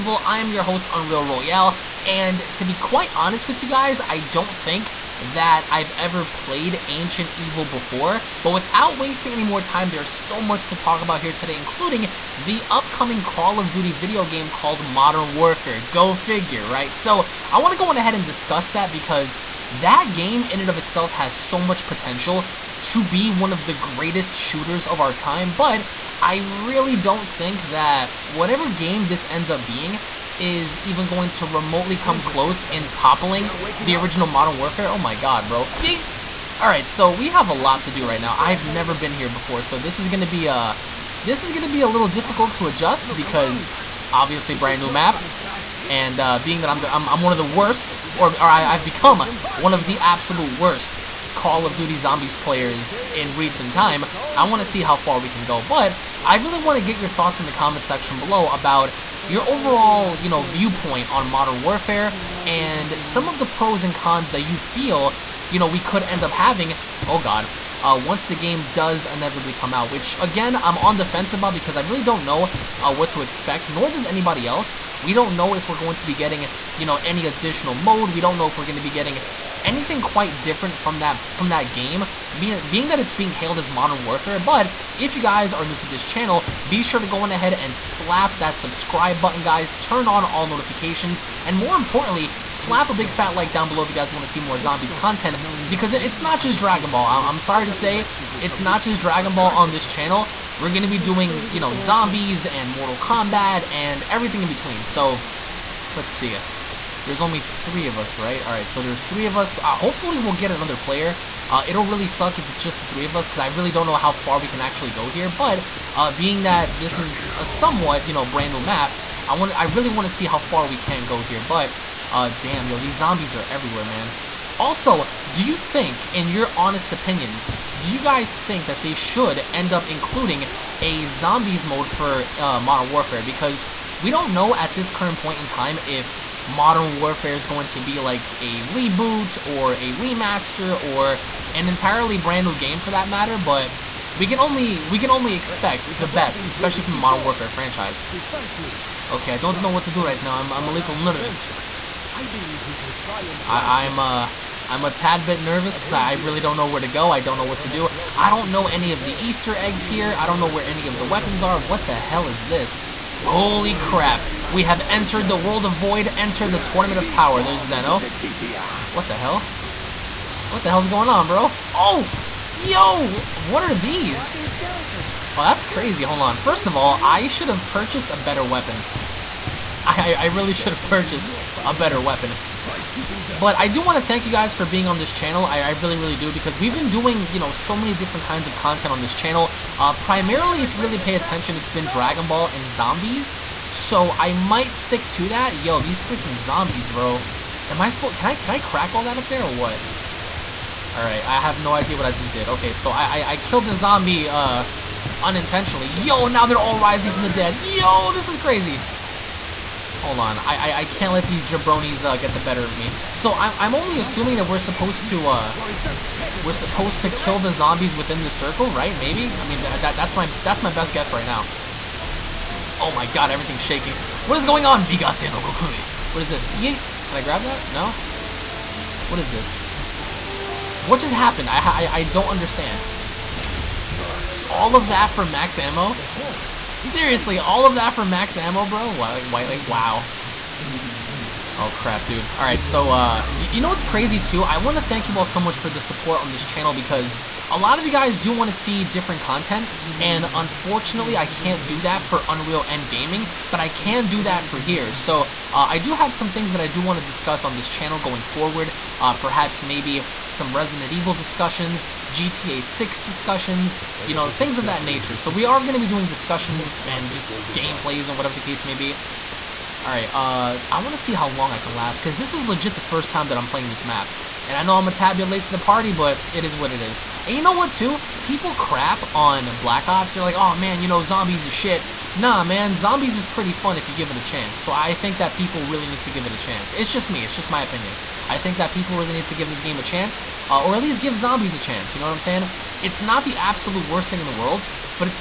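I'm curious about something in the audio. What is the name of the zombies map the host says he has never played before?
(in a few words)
Ancient Evil.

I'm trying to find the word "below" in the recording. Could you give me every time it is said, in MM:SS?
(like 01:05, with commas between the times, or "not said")
00:58, 01:33.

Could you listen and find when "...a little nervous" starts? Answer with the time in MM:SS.
02:30.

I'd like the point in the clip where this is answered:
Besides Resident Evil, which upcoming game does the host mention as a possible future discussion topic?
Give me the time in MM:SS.
04:22.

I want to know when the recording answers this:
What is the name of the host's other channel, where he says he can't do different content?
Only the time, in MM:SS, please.
04:12.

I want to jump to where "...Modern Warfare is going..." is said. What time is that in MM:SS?
02:16.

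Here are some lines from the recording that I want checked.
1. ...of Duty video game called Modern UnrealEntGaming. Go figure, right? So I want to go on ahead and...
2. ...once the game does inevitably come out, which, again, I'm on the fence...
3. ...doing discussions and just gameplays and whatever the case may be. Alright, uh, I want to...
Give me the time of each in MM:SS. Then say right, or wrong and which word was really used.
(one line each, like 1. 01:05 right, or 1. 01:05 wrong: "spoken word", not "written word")
1. 00:13 wrong: "Warfare", not "UnrealEntGaming"
2. 01:08 right
3. 04:25 right.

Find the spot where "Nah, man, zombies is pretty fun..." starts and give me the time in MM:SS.
04:42.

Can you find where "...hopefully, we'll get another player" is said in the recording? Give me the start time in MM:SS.
01:49.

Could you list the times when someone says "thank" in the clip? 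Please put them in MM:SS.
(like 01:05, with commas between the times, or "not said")
03:04, 04:04.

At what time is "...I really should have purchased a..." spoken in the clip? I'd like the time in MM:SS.
03:00.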